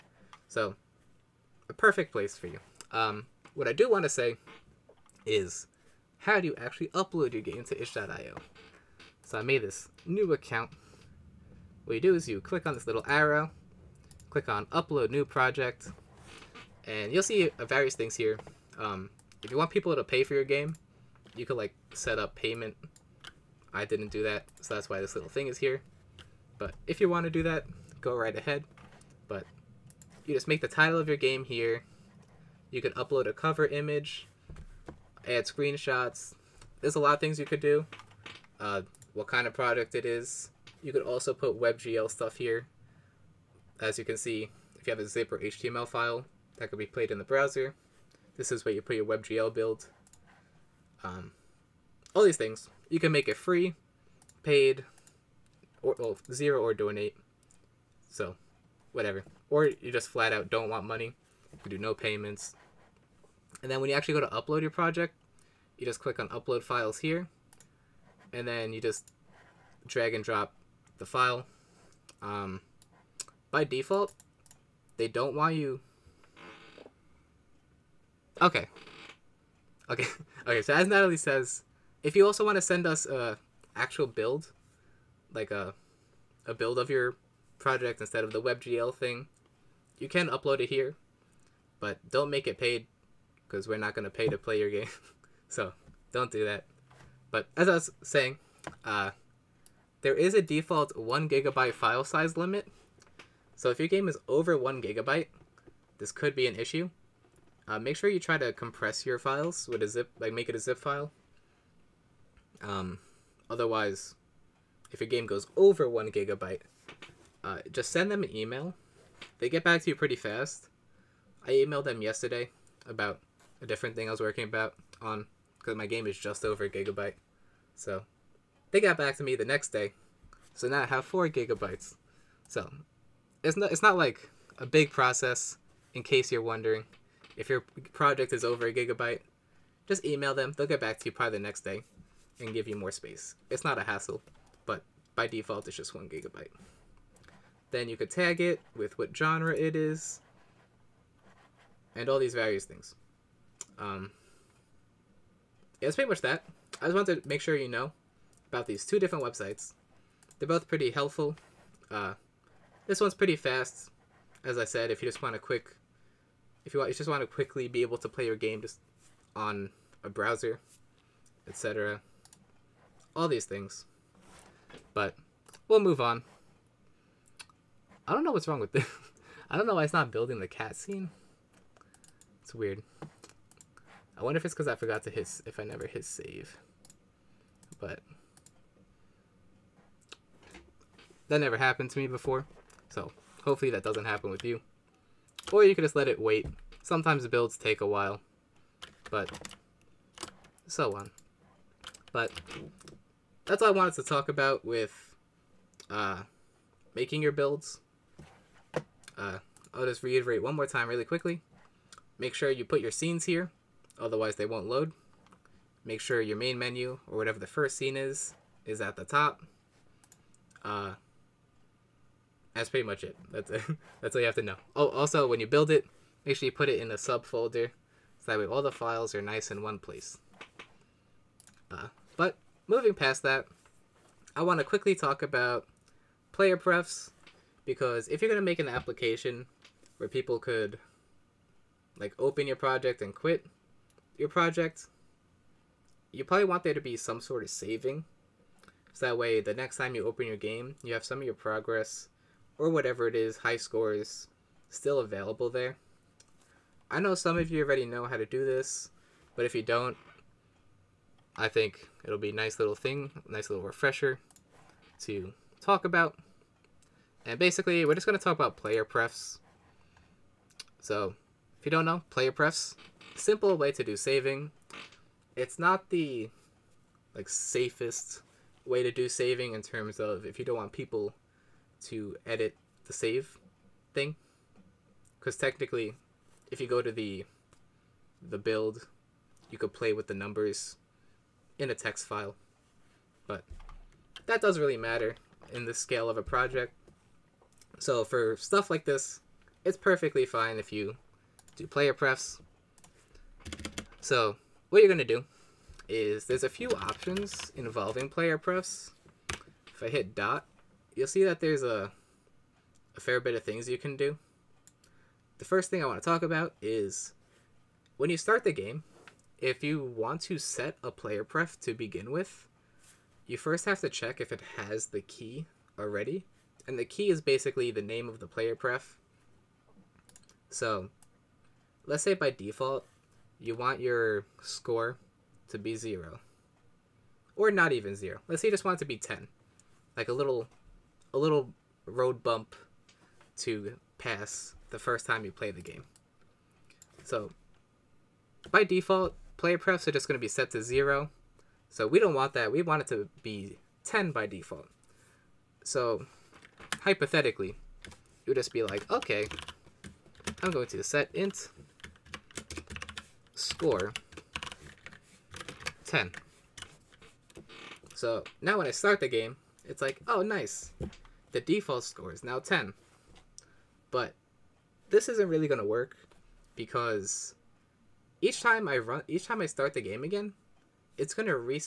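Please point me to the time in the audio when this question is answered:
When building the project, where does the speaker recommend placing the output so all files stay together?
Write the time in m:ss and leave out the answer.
3:46.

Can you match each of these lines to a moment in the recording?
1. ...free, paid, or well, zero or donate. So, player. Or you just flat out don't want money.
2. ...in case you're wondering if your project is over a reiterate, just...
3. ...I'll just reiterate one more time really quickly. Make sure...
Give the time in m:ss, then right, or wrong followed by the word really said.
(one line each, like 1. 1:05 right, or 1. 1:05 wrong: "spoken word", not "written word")
1. 0:53 wrong: "whatever", not "player"
2. 2:15 wrong: "gigabyte", not "reiterate"
3. 3:29 right.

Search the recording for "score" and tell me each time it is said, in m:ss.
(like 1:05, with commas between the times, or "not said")
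4:13, 5:34, 6:03, 6:11.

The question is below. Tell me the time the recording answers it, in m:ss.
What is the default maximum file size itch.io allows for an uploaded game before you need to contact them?
1:40.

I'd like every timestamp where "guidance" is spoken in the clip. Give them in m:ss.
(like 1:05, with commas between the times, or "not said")
not said.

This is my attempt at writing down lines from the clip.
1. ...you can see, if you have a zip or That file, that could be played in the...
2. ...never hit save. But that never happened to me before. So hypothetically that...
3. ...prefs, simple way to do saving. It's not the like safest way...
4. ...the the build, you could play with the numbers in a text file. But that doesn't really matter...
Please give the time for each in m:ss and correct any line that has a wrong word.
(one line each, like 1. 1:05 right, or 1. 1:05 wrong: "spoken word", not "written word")
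1. 0:43 wrong: "HTML", not "That"
2. 3:05 wrong: "hopefully", not "hypothetically"
3. 4:32 right
4. 4:46 right.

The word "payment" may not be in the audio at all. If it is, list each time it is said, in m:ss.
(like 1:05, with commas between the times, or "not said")
0:22, 1:01.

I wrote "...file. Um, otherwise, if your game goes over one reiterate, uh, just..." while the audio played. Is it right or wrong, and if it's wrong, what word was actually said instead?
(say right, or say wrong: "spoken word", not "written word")
wrong: "gigabyte", not "reiterate".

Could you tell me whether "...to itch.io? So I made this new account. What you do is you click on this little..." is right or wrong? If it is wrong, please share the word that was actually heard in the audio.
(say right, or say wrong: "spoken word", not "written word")
right.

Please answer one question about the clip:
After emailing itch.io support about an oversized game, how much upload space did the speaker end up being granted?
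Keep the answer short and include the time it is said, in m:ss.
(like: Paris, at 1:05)
4 gigabytes, at 2:11.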